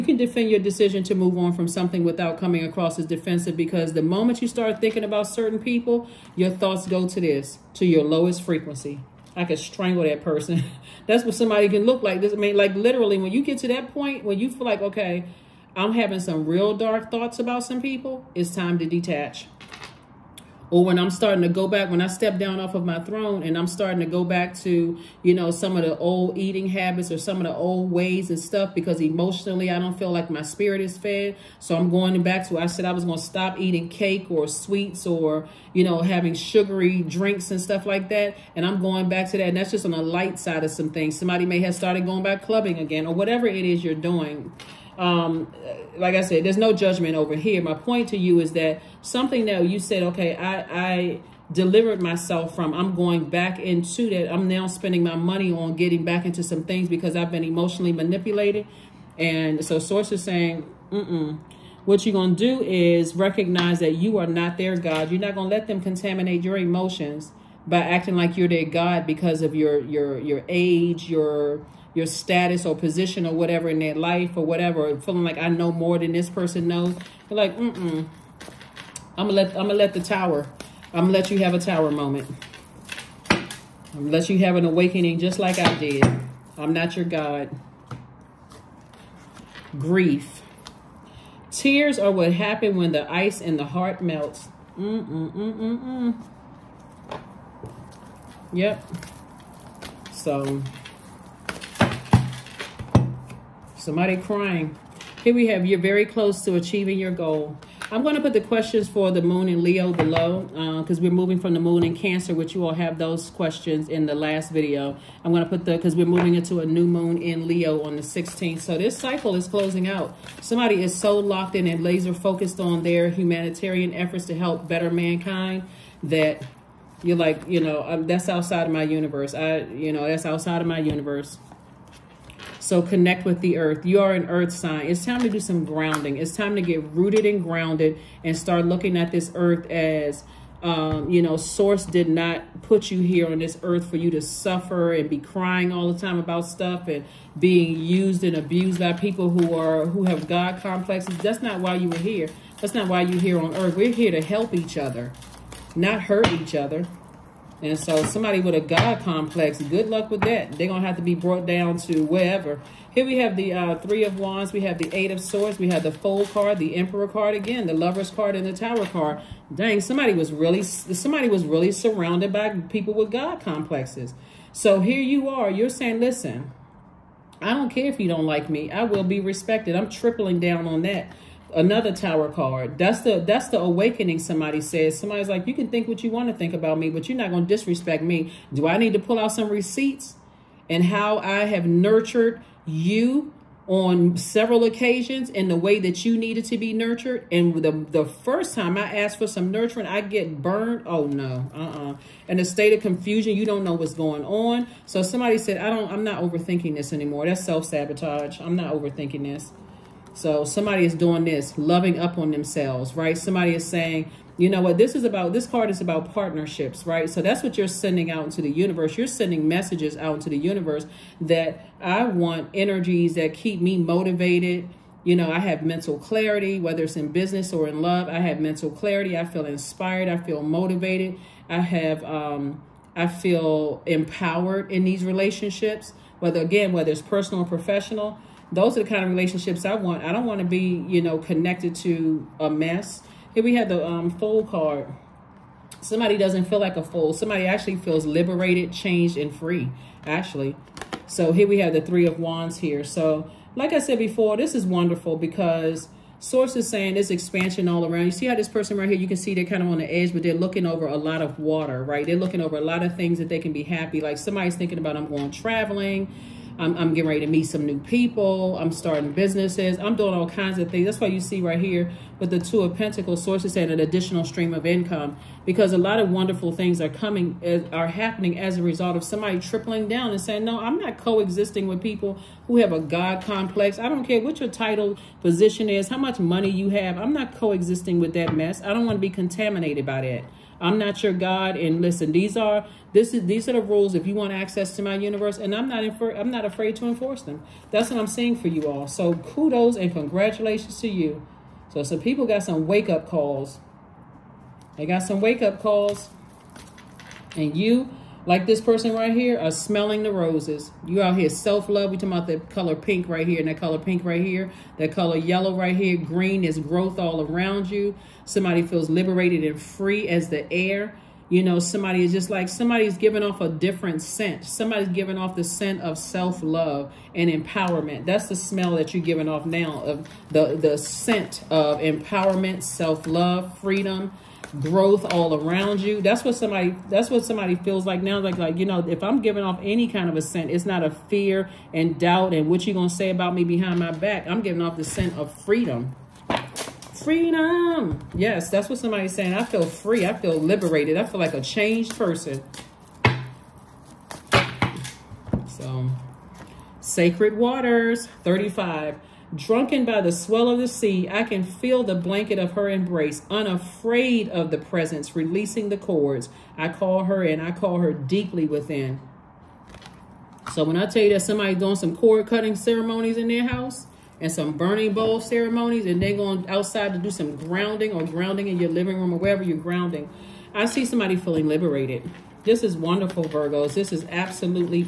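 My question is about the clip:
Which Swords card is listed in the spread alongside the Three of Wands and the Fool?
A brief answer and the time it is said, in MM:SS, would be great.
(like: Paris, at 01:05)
Eight of Swords, at 02:44.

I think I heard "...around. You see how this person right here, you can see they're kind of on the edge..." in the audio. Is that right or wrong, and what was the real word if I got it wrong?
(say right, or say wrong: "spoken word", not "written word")
right.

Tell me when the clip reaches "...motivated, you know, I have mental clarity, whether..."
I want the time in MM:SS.
03:43.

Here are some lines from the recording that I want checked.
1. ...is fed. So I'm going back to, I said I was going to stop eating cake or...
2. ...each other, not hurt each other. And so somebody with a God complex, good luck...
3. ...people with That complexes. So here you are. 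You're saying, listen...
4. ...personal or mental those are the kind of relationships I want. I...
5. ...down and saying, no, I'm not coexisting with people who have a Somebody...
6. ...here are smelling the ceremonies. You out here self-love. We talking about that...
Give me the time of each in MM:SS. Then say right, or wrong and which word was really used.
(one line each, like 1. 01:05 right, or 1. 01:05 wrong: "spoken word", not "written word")
1. 00:30 right
2. 02:34 right
3. 02:52 wrong: "God", not "That"
4. 03:57 wrong: "professional", not "mental"
5. 04:39 wrong: "God", not "Somebody"
6. 05:09 wrong: "roses", not "ceremonies".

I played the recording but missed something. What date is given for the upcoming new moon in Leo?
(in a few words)
16th.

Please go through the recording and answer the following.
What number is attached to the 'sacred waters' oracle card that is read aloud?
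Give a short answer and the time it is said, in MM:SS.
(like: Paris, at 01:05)
35, at 05:58.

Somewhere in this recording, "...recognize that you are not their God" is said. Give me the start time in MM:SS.
01:03.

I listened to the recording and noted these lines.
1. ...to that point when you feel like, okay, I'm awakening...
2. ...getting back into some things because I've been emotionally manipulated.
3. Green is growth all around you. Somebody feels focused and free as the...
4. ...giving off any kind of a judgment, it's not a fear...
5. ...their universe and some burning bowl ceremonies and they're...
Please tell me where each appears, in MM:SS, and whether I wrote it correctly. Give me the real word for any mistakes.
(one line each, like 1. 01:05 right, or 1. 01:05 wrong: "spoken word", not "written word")
1. 00:13 wrong: "having", not "awakening"
2. 00:55 right
3. 05:15 wrong: "liberated", not "focused"
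4. 05:39 wrong: "scent", not "judgment"
5. 06:13 wrong: "house", not "universe".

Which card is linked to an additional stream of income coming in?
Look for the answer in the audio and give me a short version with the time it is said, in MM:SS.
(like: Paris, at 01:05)
Two of Pentacles, at 04:32.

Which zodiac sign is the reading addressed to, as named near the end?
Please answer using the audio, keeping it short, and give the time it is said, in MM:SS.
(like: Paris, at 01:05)
Virgos, at 06:23.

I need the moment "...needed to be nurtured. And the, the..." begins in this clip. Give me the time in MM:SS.
03:16.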